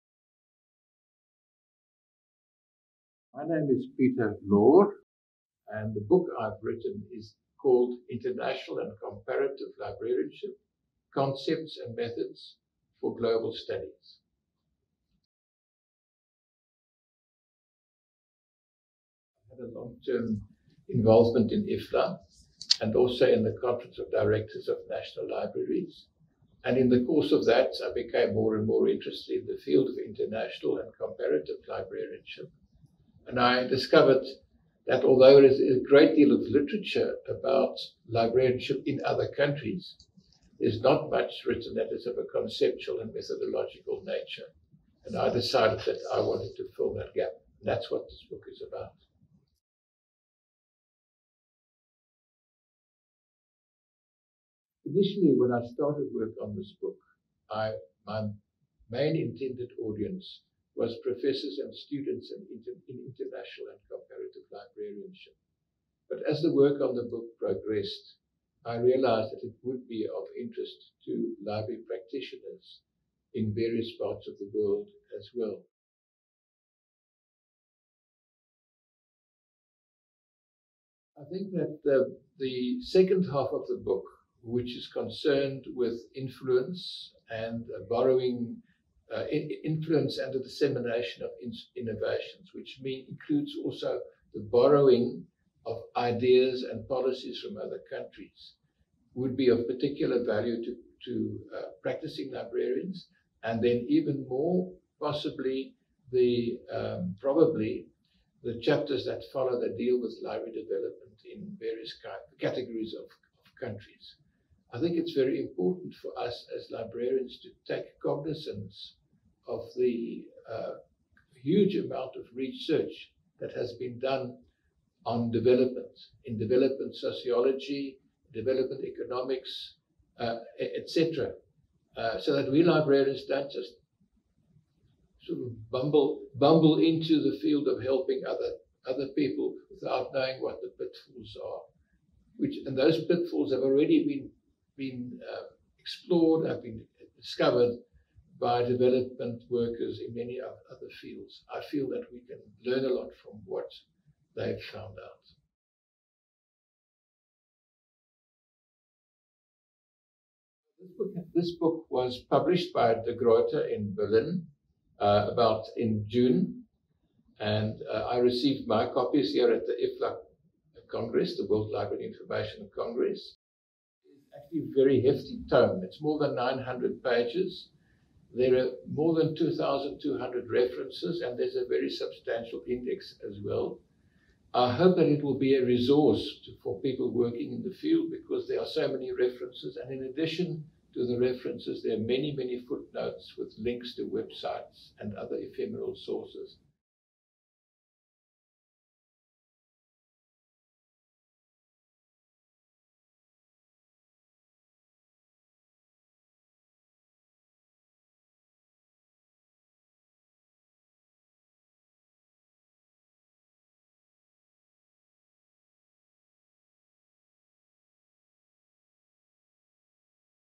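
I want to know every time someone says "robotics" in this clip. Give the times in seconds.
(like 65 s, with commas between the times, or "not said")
not said.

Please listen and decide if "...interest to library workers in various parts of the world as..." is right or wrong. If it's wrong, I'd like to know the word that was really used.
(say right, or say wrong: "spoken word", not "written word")
wrong: "practitioners", not "workers".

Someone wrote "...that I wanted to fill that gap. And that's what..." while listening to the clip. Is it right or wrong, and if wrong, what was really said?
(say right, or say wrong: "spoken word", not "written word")
right.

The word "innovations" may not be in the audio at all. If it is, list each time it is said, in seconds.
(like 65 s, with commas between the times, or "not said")
91 s.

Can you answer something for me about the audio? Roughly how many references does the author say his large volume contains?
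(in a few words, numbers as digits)
more than 2,200.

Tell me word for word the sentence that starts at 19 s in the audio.
I had a long term involvement in IFLA and also in the Conference of Directors of National Libraries.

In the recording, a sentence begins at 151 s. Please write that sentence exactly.
I feel that we can learn a lot from what they've found out.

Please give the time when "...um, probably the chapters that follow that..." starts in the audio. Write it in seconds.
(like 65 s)
106 s.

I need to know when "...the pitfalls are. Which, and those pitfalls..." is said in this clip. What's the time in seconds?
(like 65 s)
140 s.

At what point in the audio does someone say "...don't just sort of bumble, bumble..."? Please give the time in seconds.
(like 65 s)
133 s.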